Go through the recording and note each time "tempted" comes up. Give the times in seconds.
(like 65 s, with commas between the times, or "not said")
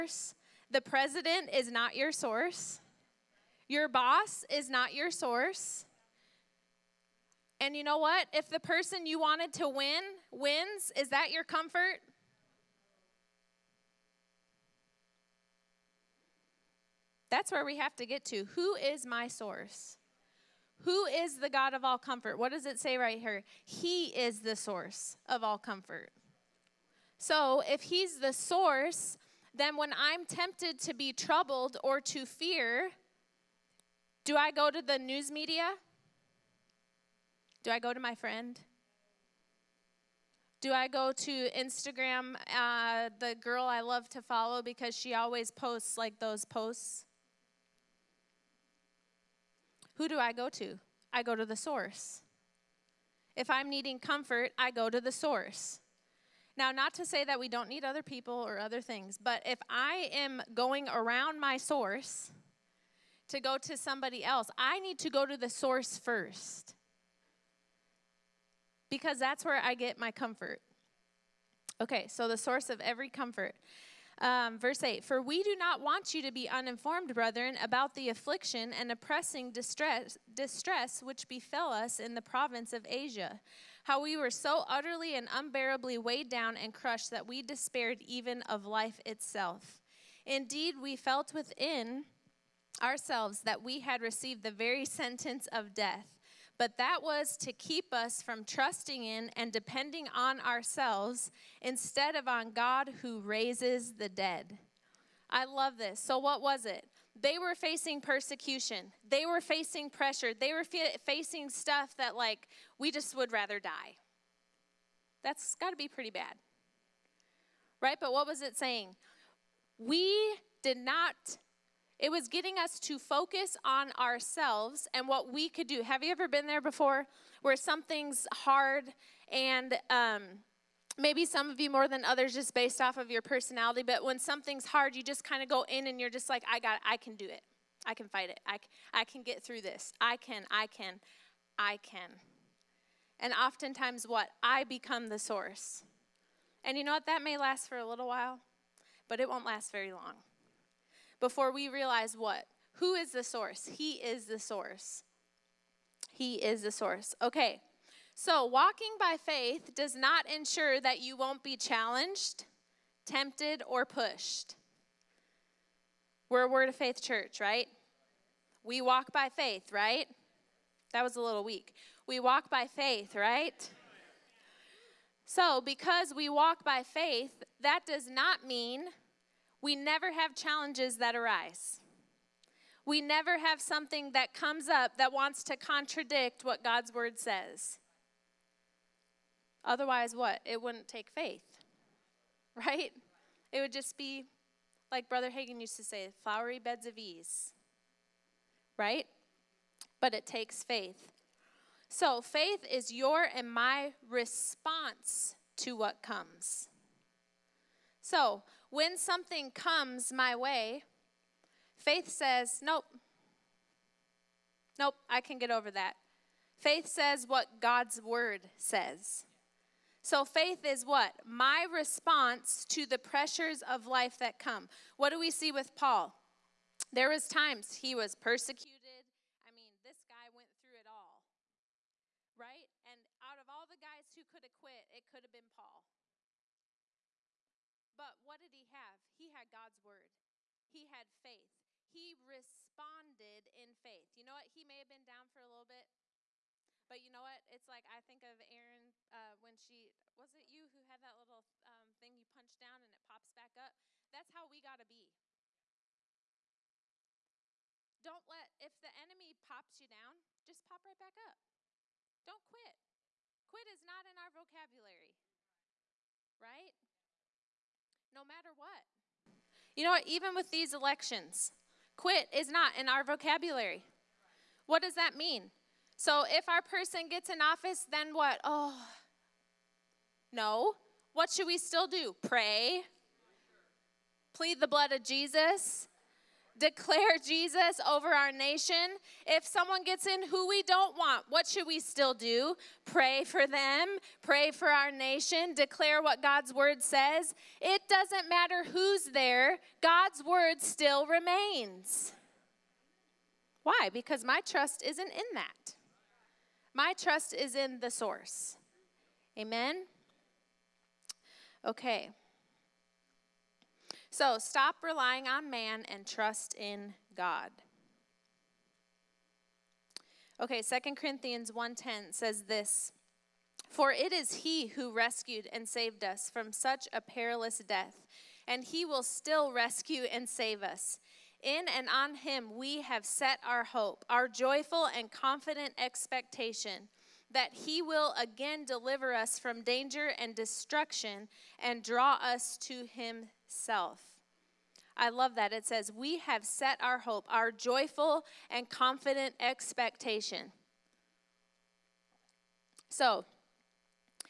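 30 s, 163 s.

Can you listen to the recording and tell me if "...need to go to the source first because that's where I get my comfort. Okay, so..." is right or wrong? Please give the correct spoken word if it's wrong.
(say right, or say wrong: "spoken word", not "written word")
right.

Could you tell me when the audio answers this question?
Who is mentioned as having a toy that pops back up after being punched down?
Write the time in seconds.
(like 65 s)
248 s.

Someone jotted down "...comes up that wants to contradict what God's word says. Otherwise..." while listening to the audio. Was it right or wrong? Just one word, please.
right.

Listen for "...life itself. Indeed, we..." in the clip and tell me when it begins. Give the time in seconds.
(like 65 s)
88 s.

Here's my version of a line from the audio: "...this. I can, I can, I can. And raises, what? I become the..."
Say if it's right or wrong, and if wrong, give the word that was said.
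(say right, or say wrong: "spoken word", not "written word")
wrong: "oftentimes", not "raises".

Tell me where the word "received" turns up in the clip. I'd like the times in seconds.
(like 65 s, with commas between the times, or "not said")
94 s.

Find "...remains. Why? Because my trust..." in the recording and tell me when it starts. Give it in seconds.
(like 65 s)
301 s.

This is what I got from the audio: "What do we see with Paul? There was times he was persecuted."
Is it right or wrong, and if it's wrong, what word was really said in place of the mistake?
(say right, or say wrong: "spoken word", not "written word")
right.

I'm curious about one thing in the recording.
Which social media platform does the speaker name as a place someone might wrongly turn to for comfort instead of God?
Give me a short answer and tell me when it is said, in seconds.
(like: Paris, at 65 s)
Instagram, at 41 s.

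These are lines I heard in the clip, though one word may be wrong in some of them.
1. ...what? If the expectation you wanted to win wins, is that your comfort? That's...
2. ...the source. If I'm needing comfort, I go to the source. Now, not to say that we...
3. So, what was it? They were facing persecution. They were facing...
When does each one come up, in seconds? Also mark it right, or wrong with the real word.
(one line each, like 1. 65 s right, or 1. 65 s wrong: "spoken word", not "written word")
1. 7 s wrong: "person", not "expectation"
2. 51 s right
3. 105 s right.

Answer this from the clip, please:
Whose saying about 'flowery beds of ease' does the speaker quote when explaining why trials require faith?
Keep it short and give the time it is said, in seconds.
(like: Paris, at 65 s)
Brother Hagin, at 195 s.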